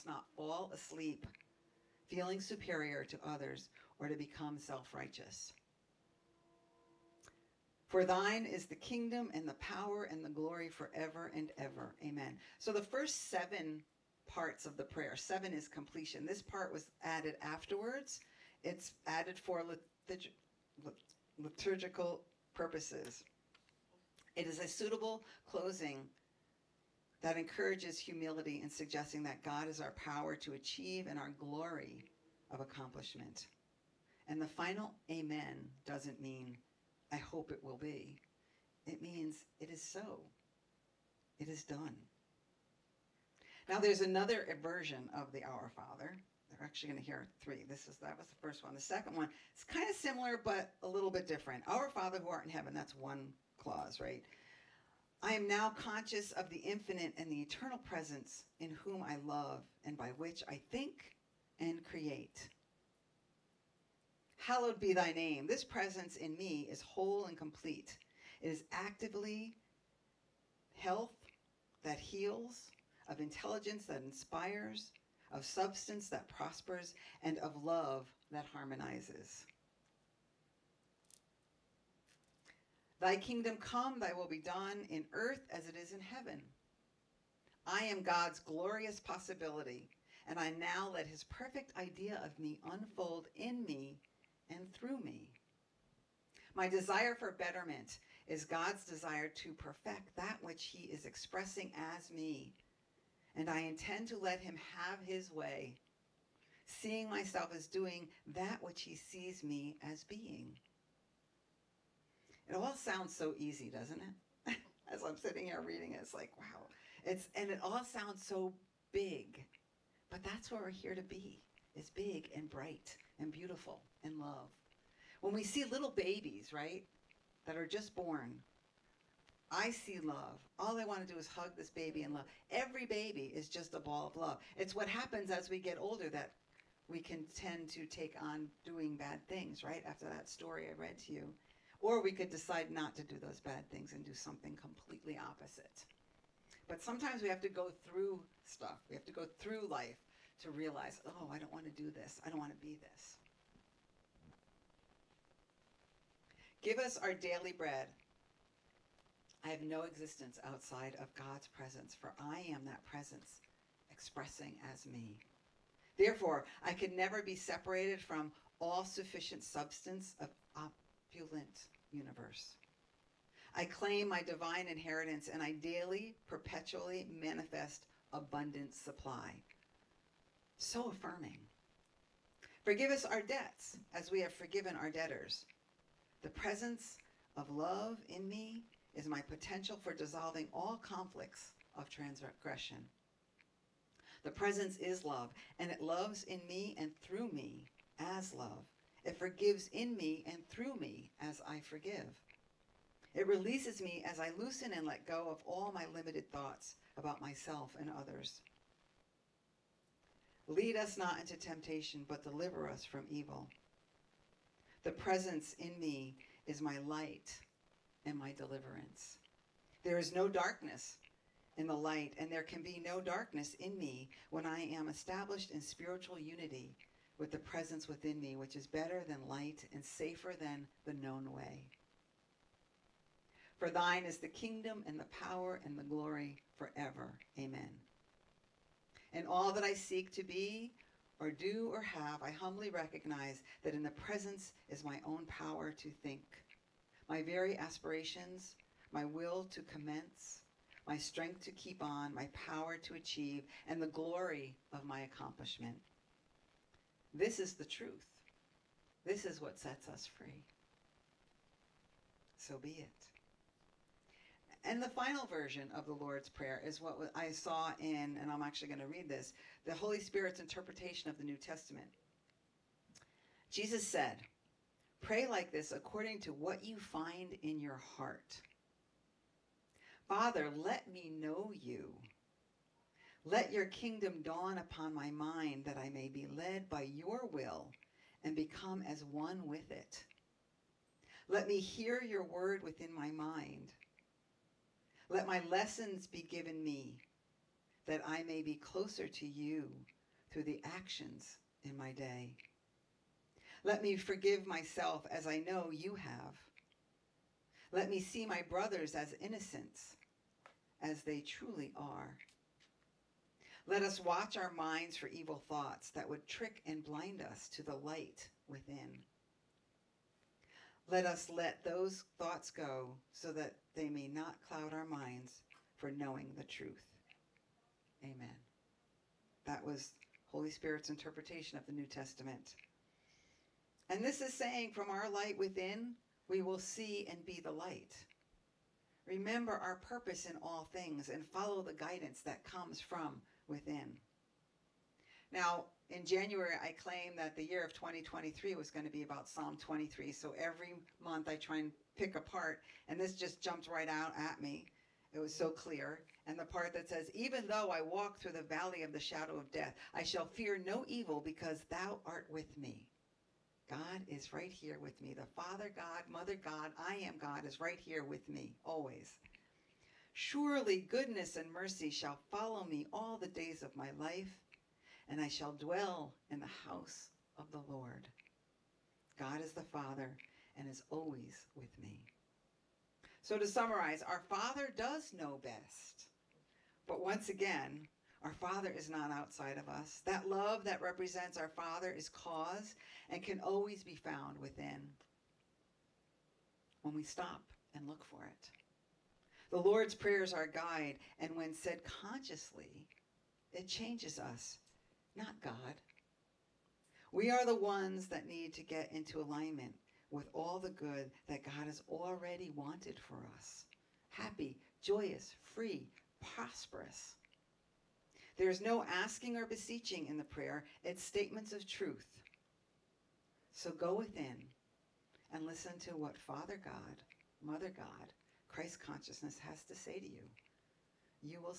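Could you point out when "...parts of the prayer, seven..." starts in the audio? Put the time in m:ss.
0:14.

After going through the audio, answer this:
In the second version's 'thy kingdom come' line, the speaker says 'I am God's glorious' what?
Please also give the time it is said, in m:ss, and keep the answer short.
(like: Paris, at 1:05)
possibility, at 1:28.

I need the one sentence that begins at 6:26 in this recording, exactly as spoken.
But once again, our Father is not outside of us.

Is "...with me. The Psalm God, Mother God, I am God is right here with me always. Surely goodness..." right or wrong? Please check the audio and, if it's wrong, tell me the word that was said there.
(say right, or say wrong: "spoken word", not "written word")
wrong: "Father", not "Psalm".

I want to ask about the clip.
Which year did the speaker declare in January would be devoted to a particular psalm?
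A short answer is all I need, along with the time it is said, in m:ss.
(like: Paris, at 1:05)
2023, at 5:47.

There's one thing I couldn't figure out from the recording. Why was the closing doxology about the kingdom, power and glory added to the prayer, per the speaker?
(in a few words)
liturgical purposes.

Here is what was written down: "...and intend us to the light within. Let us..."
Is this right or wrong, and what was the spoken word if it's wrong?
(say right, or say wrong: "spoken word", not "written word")
wrong: "blind", not "intend".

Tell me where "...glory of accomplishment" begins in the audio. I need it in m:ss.
0:31.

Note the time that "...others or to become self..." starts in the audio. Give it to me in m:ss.
0:03.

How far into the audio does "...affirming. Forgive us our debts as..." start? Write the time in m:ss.
3:00.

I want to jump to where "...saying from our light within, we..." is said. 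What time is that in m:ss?
5:34.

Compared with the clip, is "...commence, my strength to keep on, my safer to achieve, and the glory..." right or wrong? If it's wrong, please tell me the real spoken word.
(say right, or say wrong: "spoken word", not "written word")
wrong: "power", not "safer".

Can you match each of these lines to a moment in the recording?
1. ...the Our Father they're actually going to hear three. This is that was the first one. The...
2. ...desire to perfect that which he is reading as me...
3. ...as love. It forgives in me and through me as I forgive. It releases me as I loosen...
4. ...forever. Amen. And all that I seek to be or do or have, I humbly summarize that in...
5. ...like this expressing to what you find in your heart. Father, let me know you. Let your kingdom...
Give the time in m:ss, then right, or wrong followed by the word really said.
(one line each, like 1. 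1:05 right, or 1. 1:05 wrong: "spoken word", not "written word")
1. 0:45 right
2. 1:38 wrong: "expressing", not "reading"
3. 3:17 right
4. 3:56 wrong: "recognize", not "summarize"
5. 4:35 wrong: "according", not "expressing".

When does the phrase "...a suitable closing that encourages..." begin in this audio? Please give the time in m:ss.
0:24.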